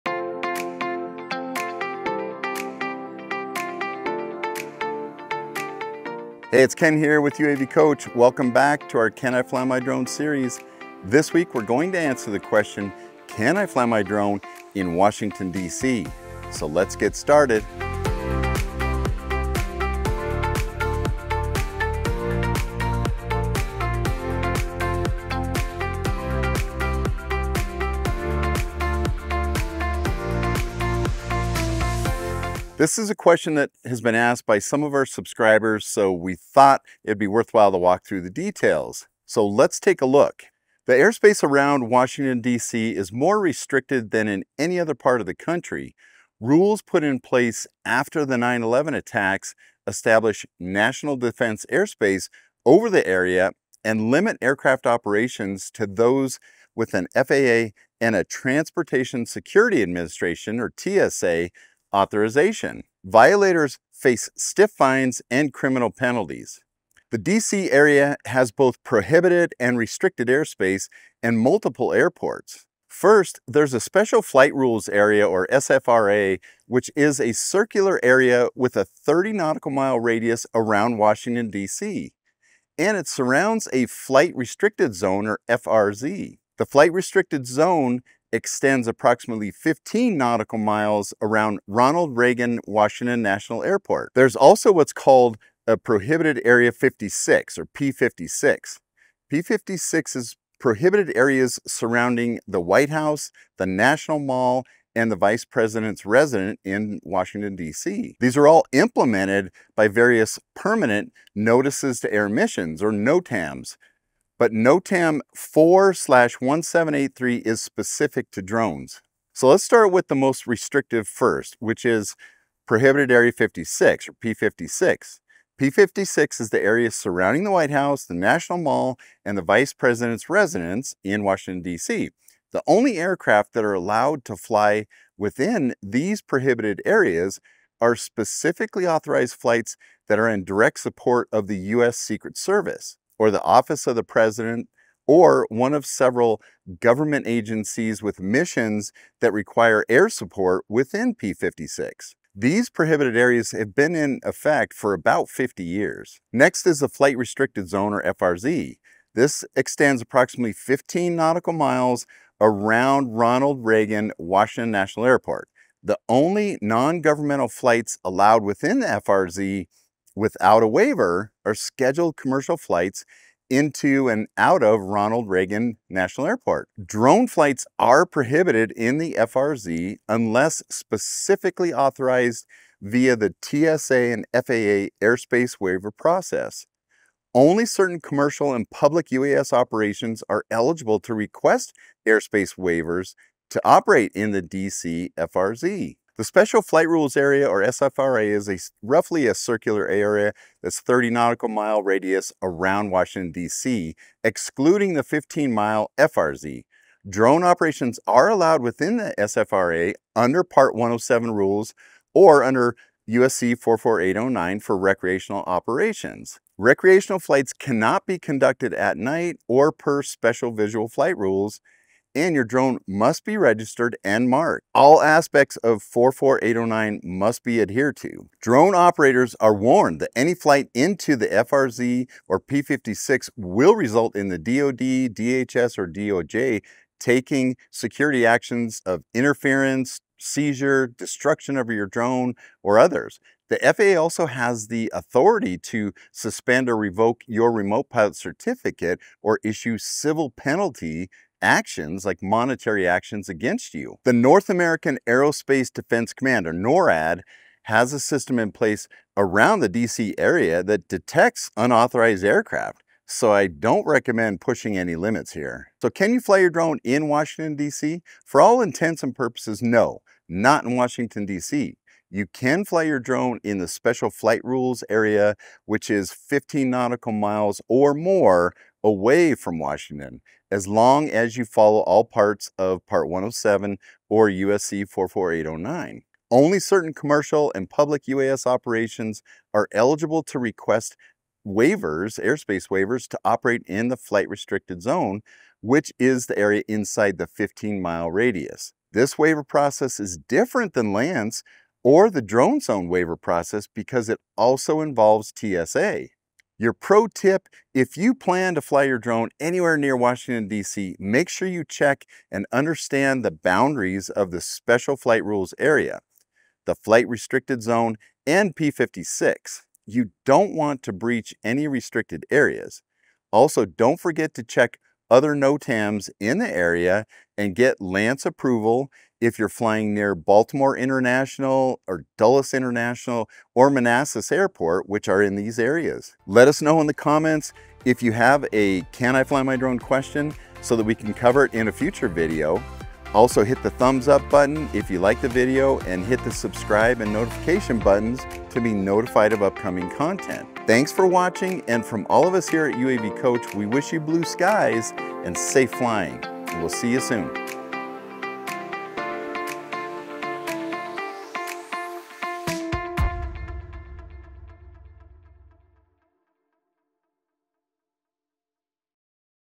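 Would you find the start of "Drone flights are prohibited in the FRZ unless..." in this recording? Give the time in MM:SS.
02:56.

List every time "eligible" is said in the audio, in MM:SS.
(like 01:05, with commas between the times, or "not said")
03:10, 04:49.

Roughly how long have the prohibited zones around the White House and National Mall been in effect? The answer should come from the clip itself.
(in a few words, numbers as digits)
50 years.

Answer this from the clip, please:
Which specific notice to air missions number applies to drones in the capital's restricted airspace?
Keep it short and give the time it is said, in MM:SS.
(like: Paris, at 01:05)
4/1783, at 01:54.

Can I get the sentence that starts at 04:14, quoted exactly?
The North American Aerospace Defense Command, or NORAD, has a system in place around the DC area that detects unauthorized aircraft.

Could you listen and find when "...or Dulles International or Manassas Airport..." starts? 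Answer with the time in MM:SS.
05:31.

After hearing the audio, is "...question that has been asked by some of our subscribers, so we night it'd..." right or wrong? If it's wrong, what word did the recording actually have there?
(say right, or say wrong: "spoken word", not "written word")
wrong: "thought", not "night".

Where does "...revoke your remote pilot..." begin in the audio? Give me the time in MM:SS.
04:06.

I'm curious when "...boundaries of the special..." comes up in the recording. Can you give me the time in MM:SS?
05:13.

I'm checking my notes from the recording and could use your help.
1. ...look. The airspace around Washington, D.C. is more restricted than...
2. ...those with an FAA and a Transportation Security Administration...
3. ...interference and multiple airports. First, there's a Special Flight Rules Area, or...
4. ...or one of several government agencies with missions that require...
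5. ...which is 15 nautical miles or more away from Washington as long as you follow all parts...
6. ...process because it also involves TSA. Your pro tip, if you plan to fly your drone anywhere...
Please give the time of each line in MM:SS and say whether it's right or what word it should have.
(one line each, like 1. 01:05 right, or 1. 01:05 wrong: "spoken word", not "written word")
1. 00:40 right
2. 00:55 right
3. 01:10 wrong: "airspace", not "interference"
4. 02:25 right
5. 04:35 right
6. 05:03 right.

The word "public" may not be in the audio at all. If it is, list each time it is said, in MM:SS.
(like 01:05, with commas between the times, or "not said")
03:08, 04:47.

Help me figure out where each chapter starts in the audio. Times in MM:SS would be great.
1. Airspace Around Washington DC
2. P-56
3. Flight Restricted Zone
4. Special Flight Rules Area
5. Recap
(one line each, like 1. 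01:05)
1. 00:40
2. 01:59
3. 02:36
4. 03:15
5. 04:25.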